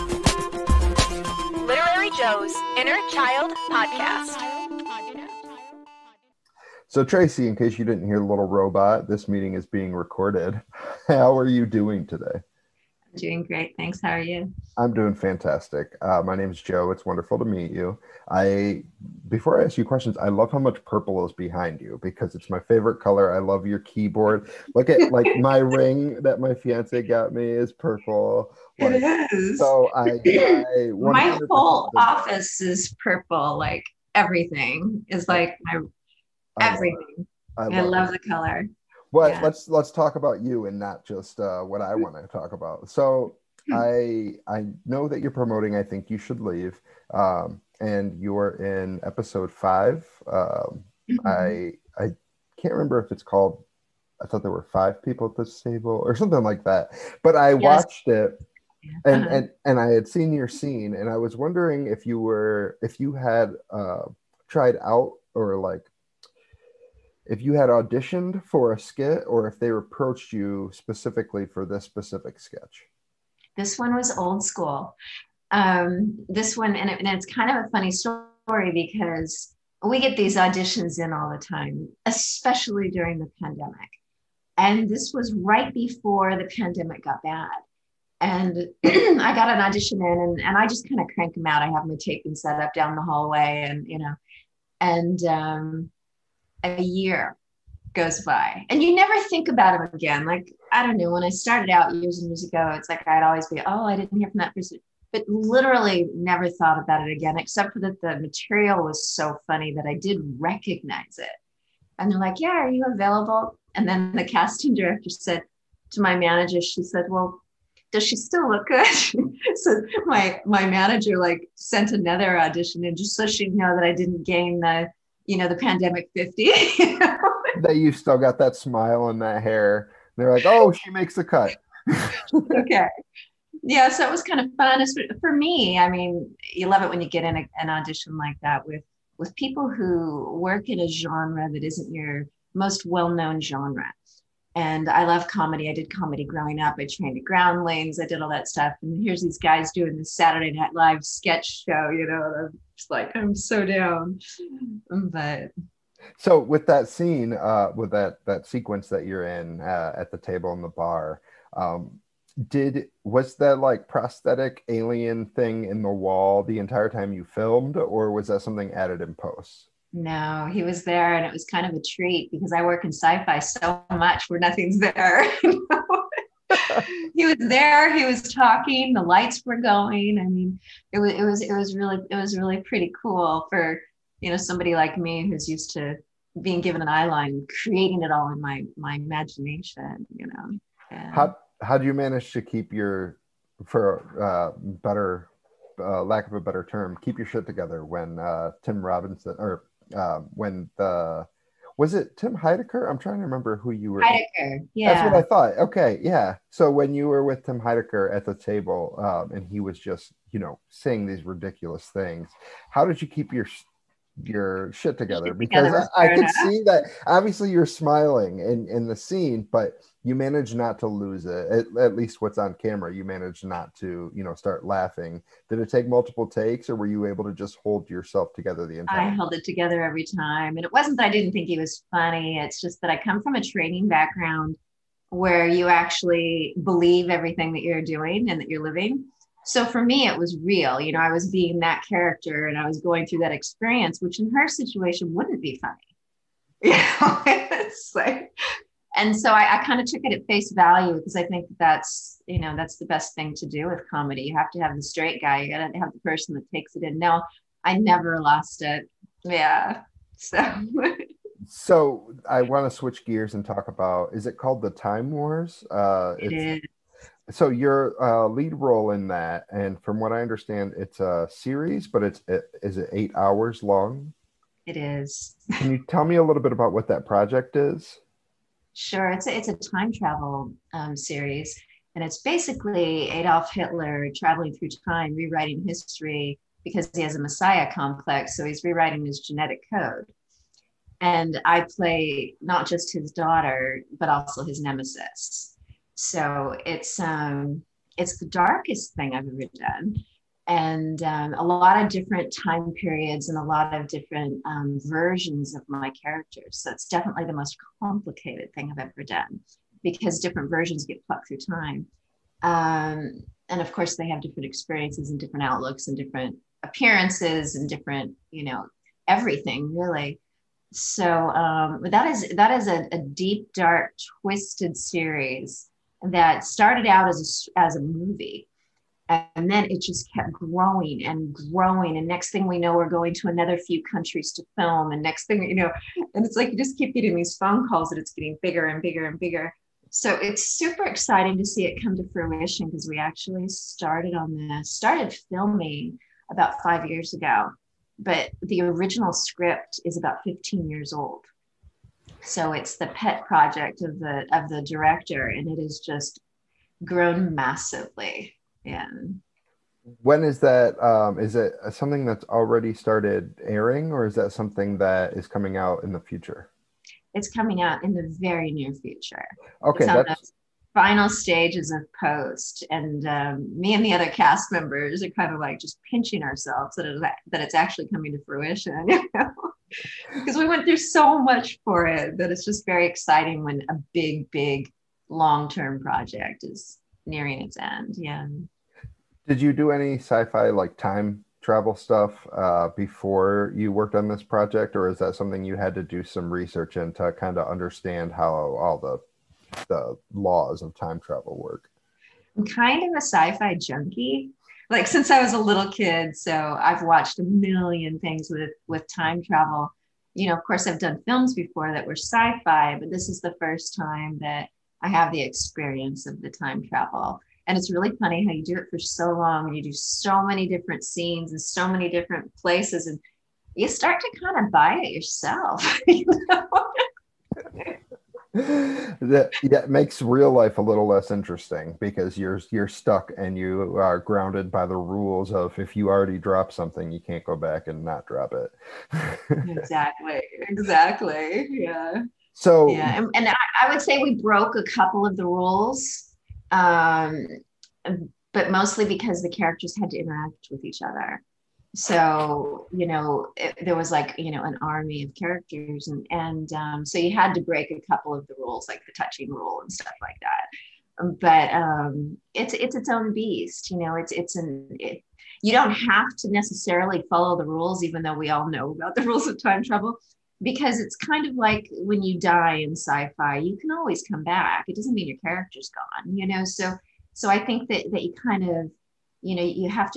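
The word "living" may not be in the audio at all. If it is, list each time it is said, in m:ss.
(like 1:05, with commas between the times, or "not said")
3:58.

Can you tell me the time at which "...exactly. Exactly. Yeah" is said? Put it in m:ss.
7:19.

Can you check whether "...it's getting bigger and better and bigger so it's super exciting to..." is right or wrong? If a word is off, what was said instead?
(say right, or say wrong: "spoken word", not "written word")
wrong: "bigger", not "better".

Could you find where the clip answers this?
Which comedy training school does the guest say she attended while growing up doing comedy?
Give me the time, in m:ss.
2:27.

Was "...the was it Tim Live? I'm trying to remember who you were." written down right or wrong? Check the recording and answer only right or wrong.
wrong.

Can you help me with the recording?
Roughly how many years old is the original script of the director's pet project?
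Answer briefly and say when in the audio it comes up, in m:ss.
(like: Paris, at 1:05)
15, at 5:50.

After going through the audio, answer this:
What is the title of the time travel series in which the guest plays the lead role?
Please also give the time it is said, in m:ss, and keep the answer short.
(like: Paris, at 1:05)
Time Wars, at 4:24.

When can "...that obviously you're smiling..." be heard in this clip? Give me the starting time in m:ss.
3:36.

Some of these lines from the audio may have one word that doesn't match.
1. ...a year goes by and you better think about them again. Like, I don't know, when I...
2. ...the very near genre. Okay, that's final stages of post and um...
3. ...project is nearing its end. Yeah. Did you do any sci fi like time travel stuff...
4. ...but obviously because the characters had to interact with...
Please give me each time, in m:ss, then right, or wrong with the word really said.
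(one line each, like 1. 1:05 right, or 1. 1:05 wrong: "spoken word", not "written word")
1. 1:36 wrong: "never", not "better"
2. 6:07 wrong: "future", not "genre"
3. 6:25 right
4. 7:28 wrong: "mostly", not "obviously".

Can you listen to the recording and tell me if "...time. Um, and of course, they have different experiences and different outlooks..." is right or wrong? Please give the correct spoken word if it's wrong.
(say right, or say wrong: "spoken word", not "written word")
right.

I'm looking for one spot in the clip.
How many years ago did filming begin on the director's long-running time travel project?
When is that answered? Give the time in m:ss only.
5:46.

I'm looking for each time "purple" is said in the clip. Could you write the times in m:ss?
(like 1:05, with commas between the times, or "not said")
0:20, 0:27, 0:33.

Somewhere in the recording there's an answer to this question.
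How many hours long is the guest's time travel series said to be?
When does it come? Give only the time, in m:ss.
4:32.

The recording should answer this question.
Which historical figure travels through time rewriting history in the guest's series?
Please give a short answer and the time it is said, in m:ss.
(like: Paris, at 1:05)
Adolf Hitler, at 4:43.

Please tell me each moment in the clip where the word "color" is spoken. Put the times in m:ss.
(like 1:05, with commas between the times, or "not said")
0:23, 0:38.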